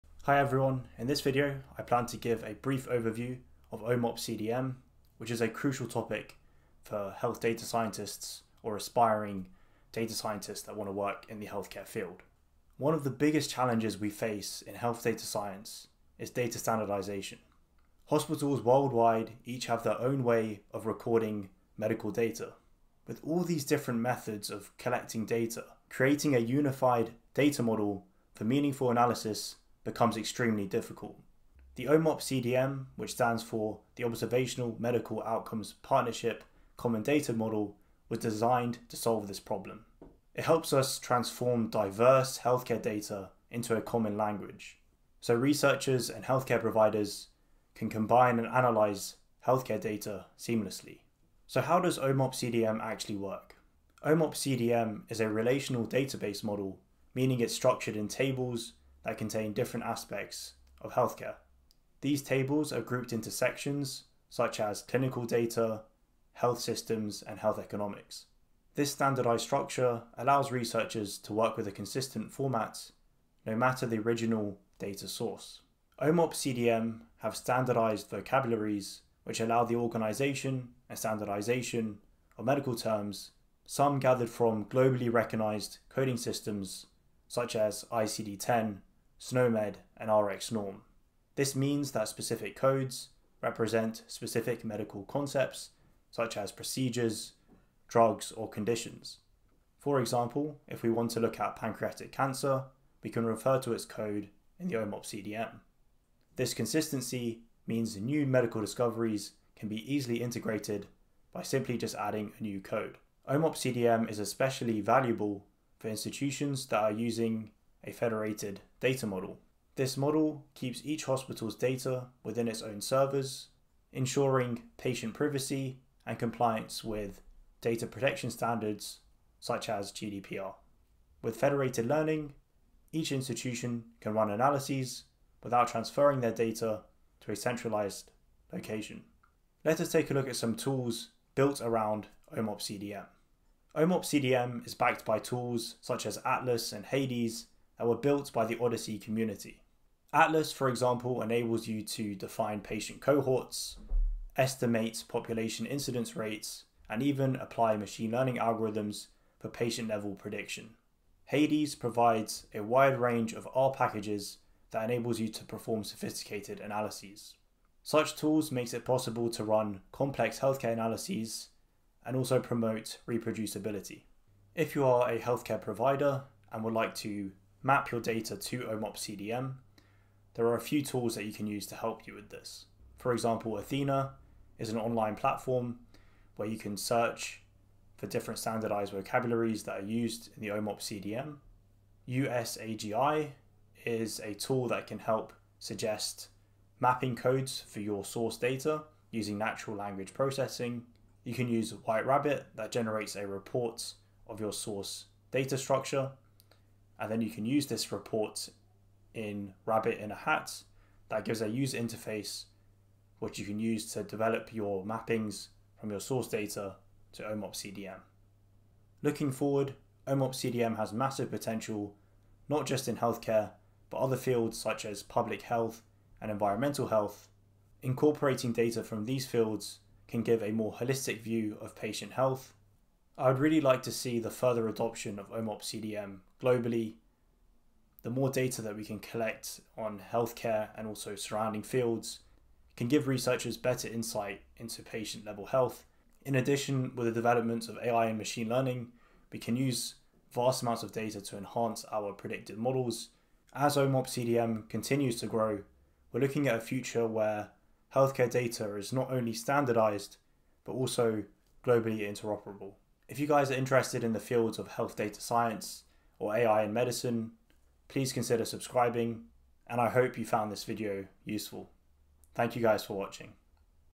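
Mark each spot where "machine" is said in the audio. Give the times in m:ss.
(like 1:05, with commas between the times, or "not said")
2:37, 4:08.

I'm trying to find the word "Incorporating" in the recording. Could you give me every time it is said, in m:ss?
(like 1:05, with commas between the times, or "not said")
3:47.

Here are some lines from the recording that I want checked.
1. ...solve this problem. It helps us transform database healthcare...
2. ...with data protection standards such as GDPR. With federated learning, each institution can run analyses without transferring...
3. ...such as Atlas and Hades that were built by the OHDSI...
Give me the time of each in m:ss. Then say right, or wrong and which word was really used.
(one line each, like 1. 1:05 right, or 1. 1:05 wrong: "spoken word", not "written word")
1. 0:38 wrong: "diverse", not "database"
2. 2:06 right
3. 2:25 right.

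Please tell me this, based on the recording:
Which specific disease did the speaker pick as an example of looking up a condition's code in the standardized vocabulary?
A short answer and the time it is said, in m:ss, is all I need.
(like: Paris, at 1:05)
Pancreatic cancer, at 1:41.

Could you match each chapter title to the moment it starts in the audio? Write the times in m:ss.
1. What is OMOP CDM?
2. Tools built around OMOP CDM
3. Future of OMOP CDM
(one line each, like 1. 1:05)
1. 0:51
2. 2:19
3. 3:38.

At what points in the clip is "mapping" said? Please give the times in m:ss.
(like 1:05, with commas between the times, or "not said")
3:16, 3:34.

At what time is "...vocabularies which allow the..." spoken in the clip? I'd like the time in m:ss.
1:18.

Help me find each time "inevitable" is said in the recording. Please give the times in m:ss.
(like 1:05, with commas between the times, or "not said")
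not said.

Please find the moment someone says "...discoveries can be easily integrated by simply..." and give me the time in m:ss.
1:48.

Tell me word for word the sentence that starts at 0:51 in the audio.
So, how does OMOP CDM actually work?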